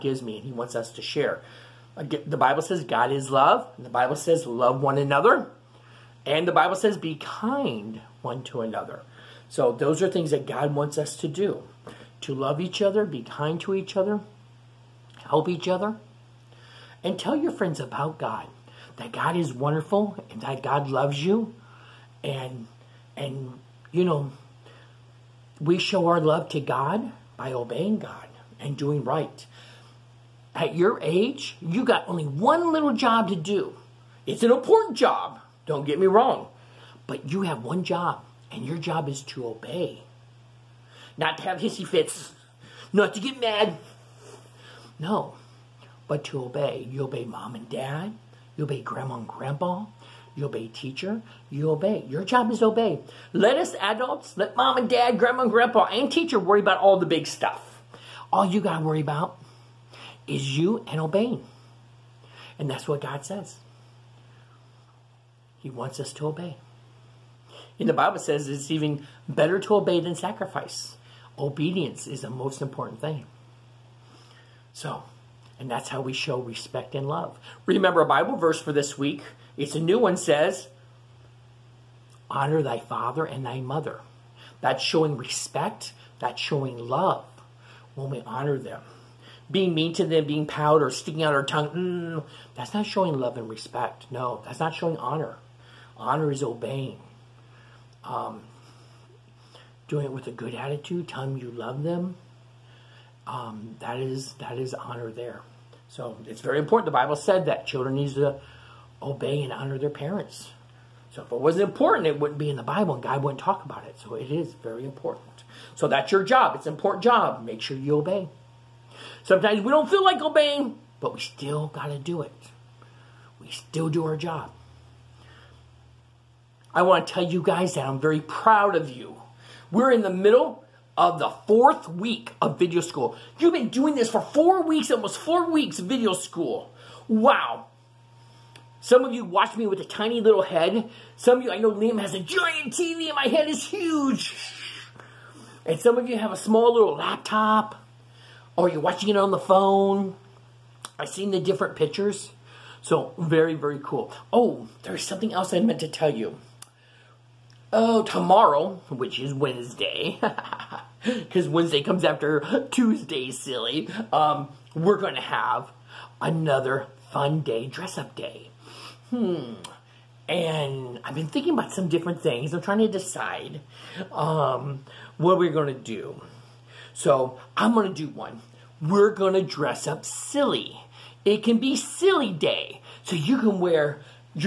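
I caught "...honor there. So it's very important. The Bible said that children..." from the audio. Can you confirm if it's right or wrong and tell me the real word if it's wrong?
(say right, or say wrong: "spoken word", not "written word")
right.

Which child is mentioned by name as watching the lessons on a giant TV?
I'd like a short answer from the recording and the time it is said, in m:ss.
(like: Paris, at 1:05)
Liam, at 2:21.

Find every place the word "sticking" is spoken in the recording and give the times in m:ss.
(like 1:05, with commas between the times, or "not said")
1:30.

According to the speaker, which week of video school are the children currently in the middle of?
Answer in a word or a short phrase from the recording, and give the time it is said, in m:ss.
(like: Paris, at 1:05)
4th week, at 2:11.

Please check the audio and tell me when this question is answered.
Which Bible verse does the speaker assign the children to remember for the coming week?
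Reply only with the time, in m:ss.
1:22.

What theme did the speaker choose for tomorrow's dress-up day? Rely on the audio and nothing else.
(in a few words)
Silly day.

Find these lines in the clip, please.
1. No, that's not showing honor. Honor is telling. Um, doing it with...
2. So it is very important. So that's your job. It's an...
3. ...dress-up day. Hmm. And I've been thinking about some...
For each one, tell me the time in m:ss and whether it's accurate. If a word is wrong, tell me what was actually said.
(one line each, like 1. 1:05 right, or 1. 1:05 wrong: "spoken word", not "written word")
1. 1:34 wrong: "obeying", not "telling"
2. 1:54 right
3. 2:47 right.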